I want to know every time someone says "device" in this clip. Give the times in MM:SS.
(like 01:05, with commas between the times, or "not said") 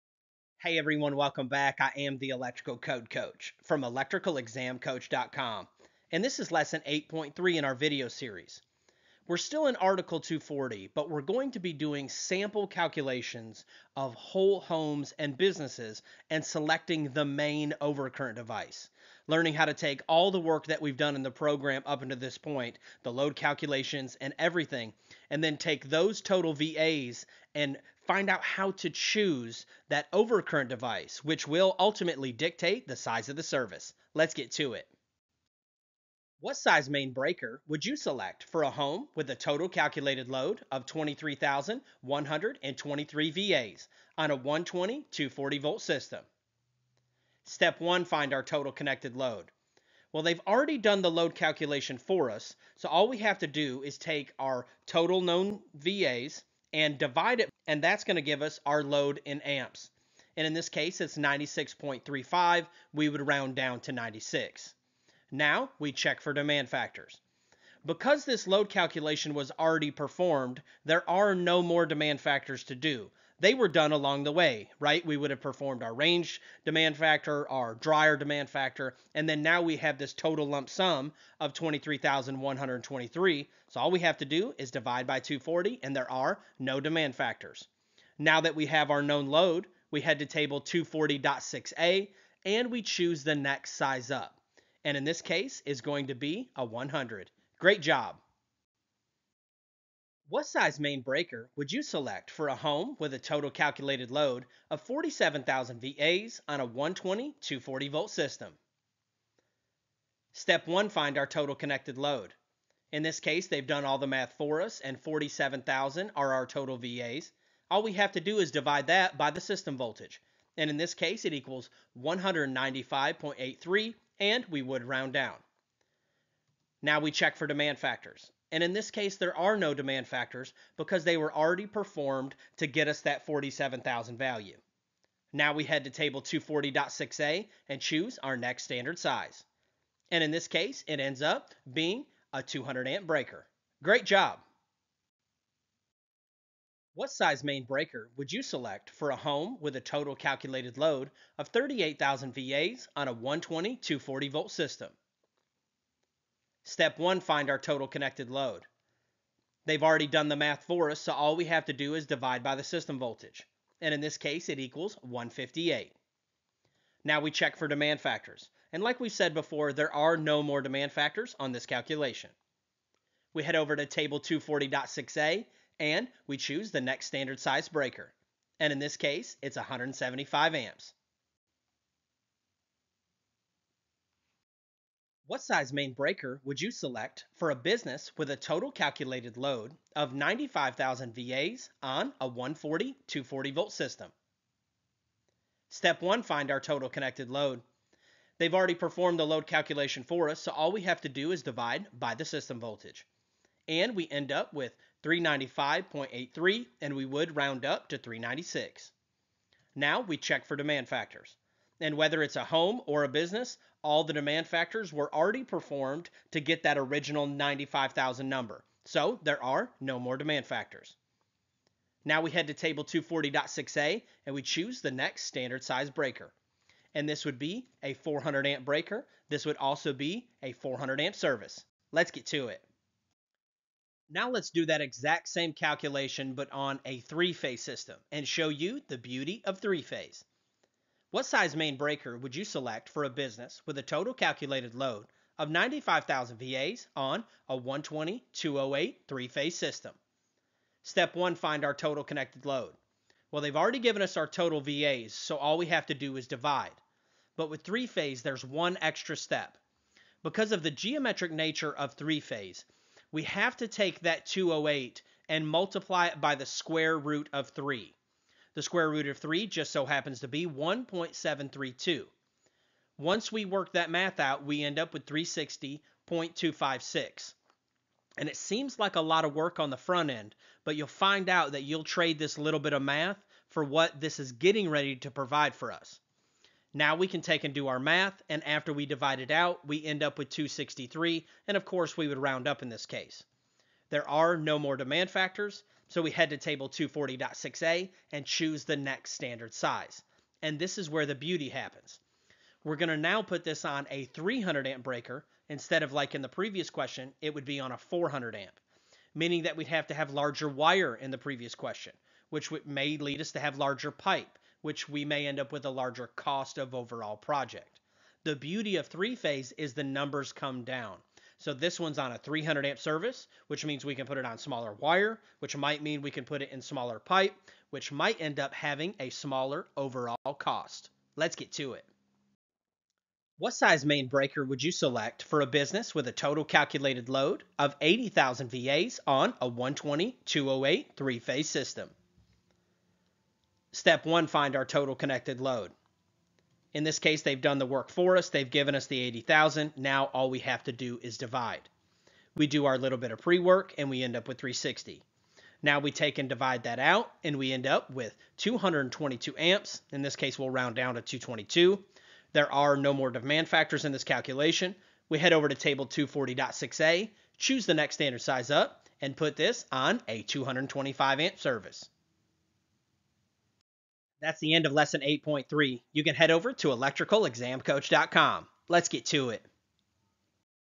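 00:18, 00:30.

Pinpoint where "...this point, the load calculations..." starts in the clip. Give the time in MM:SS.
00:22.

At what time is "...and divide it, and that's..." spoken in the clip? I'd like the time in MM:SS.
00:56.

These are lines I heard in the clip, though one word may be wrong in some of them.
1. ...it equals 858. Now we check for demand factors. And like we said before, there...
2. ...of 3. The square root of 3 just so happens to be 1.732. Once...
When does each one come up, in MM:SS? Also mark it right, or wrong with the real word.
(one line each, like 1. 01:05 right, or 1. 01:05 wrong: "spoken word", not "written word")
1. 02:44 wrong: "158", not "858"
2. 04:27 right.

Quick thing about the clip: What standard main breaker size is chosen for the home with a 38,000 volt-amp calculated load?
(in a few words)
175 amps.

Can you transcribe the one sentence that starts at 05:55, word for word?
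Now we take and divide that out and we end up with 222 amps.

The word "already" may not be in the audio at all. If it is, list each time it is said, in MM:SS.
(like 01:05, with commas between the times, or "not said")
00:50, 01:09, 02:11, 02:39, 03:18, 03:35, 04:13.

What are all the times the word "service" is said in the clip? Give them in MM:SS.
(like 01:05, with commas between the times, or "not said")
00:33, 03:51, 05:22, 06:11.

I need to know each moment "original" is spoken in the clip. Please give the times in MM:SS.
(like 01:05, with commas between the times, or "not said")
03:36.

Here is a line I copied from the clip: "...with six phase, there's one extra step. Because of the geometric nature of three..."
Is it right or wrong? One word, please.
wrong.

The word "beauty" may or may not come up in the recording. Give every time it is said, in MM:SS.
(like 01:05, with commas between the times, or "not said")
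03:58, 05:01, 05:18.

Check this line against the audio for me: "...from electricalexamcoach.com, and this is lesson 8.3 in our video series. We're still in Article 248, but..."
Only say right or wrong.
wrong.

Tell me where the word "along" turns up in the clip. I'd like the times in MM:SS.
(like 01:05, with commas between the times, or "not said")
01:13.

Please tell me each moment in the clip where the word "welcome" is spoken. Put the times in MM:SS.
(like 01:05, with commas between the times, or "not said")
00:01.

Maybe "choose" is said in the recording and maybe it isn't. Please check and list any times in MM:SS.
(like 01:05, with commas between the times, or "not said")
00:28, 01:32, 02:17, 02:56, 03:44, 04:58, 06:07.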